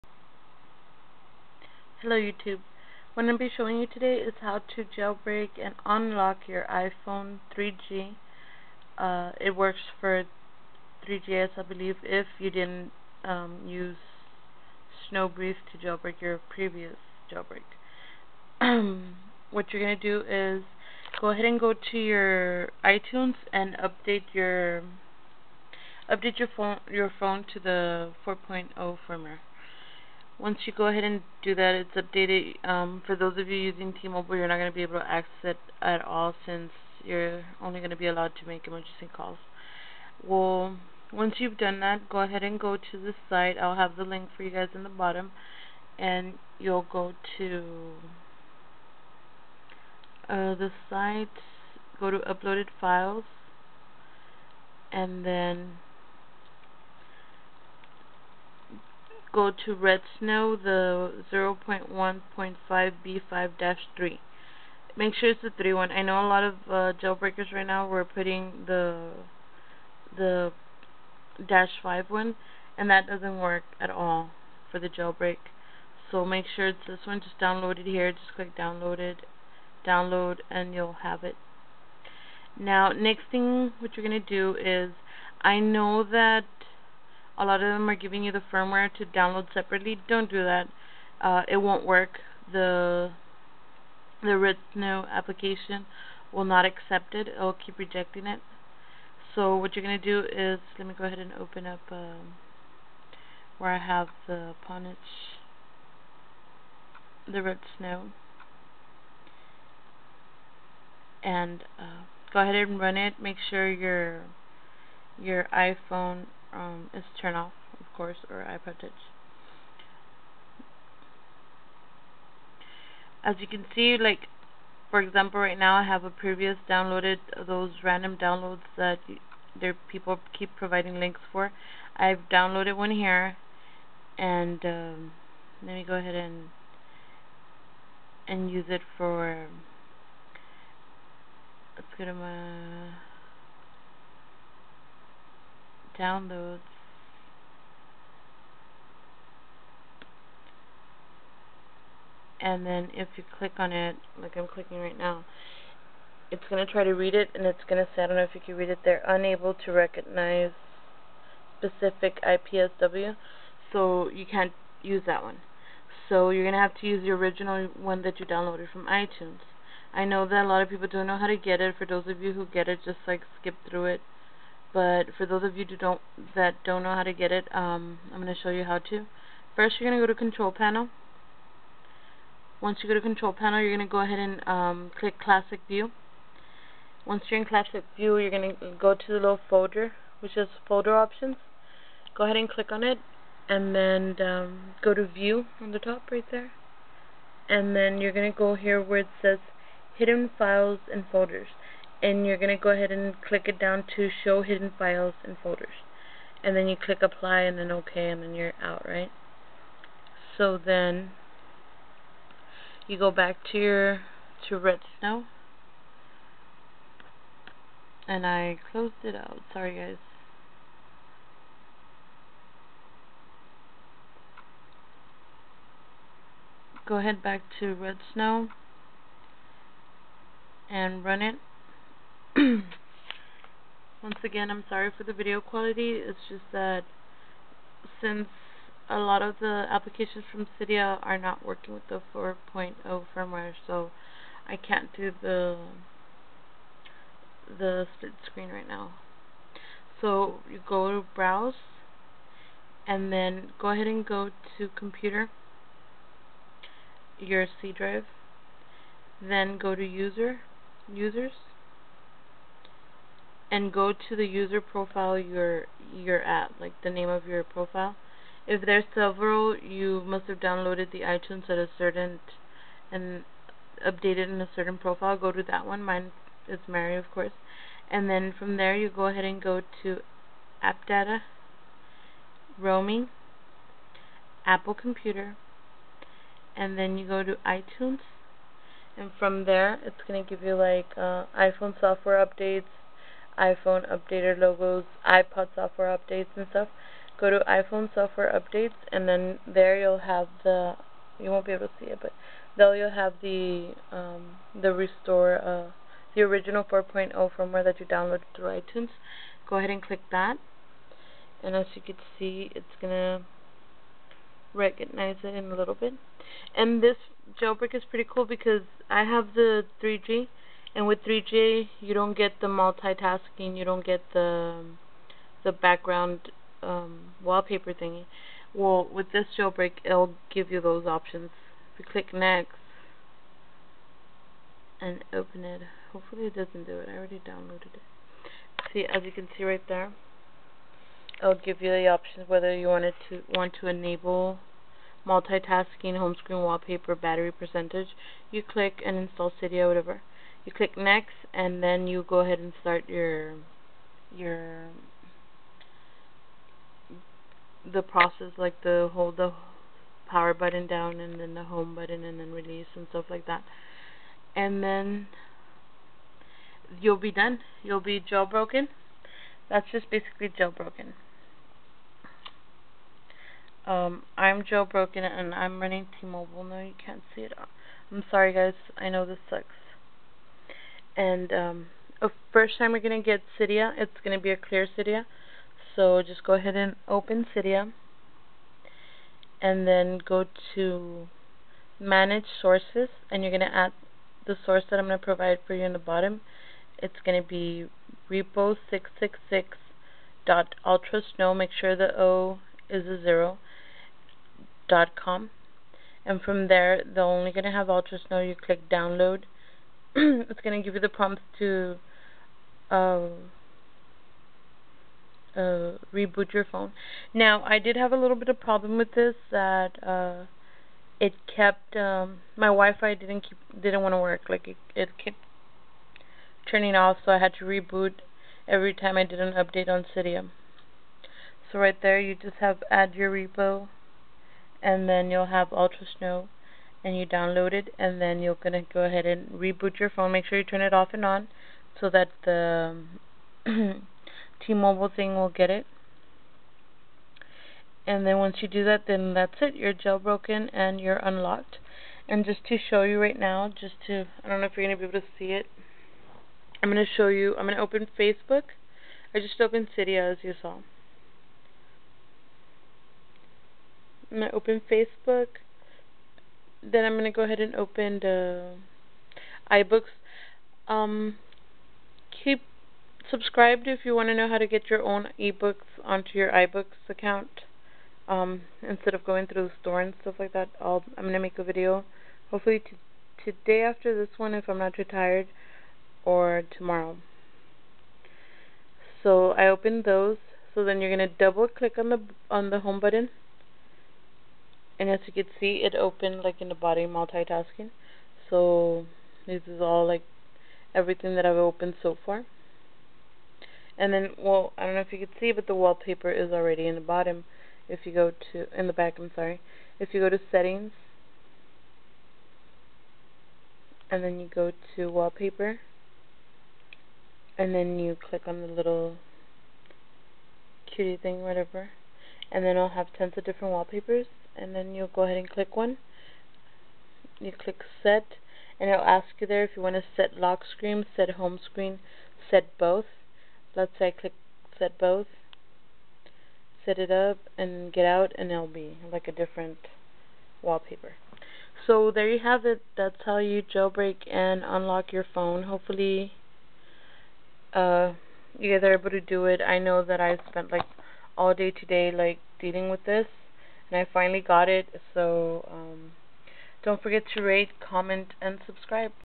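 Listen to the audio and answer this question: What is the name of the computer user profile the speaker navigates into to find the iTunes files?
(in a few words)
Mary.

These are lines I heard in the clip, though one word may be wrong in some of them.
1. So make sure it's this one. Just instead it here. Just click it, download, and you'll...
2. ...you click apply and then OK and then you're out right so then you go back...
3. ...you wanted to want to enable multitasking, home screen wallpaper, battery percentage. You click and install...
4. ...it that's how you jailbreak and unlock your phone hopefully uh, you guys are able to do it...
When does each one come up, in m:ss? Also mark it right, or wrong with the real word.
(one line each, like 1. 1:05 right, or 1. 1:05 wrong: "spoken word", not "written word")
1. 1:16 wrong: "download", not "instead"
2. 3:26 right
3. 5:42 right
4. 9:02 right.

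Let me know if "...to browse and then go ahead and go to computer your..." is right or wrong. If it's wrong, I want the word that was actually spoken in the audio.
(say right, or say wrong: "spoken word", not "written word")
right.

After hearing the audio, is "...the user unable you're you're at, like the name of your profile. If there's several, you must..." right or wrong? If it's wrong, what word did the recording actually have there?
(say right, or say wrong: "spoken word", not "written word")
wrong: "profile", not "unable".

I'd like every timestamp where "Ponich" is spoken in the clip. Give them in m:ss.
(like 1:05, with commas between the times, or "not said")
1:44.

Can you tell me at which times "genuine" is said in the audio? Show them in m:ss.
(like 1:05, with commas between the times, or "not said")
not said.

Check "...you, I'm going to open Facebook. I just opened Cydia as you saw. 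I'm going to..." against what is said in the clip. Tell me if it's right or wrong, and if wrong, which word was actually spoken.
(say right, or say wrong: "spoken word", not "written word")
right.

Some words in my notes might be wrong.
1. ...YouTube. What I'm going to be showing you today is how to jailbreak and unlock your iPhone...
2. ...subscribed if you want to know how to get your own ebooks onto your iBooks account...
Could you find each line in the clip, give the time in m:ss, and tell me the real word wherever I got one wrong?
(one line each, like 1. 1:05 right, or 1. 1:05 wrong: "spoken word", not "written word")
1. 0:02 right
2. 7:53 right.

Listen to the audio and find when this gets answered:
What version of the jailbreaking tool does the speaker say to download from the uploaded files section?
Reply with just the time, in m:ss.
1:01.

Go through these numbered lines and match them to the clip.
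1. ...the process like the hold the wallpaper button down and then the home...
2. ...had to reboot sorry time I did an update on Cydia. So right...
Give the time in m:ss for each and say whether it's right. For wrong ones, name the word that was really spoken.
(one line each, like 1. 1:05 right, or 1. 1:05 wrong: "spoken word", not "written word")
1. 5:57 wrong: "power", not "wallpaper"
2. 7:07 wrong: "every", not "sorry".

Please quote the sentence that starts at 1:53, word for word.
Make sure your your iPhone um, is turn off, of course, or iPod Touch.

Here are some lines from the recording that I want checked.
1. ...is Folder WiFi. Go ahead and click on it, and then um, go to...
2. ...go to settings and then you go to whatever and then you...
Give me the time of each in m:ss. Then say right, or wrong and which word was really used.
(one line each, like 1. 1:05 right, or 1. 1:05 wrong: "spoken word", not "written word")
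1. 3:10 wrong: "Options", not "WiFi"
2. 8:29 wrong: "wallpaper", not "whatever".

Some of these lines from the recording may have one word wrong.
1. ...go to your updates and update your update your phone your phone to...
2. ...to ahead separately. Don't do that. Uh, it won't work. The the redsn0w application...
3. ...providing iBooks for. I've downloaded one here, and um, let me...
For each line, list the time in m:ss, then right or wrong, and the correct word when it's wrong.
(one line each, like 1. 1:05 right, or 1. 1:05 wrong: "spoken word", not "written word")
1. 0:21 wrong: "iTunes", not "updates"
2. 1:28 wrong: "download", not "ahead"
3. 2:10 wrong: "links", not "iBooks".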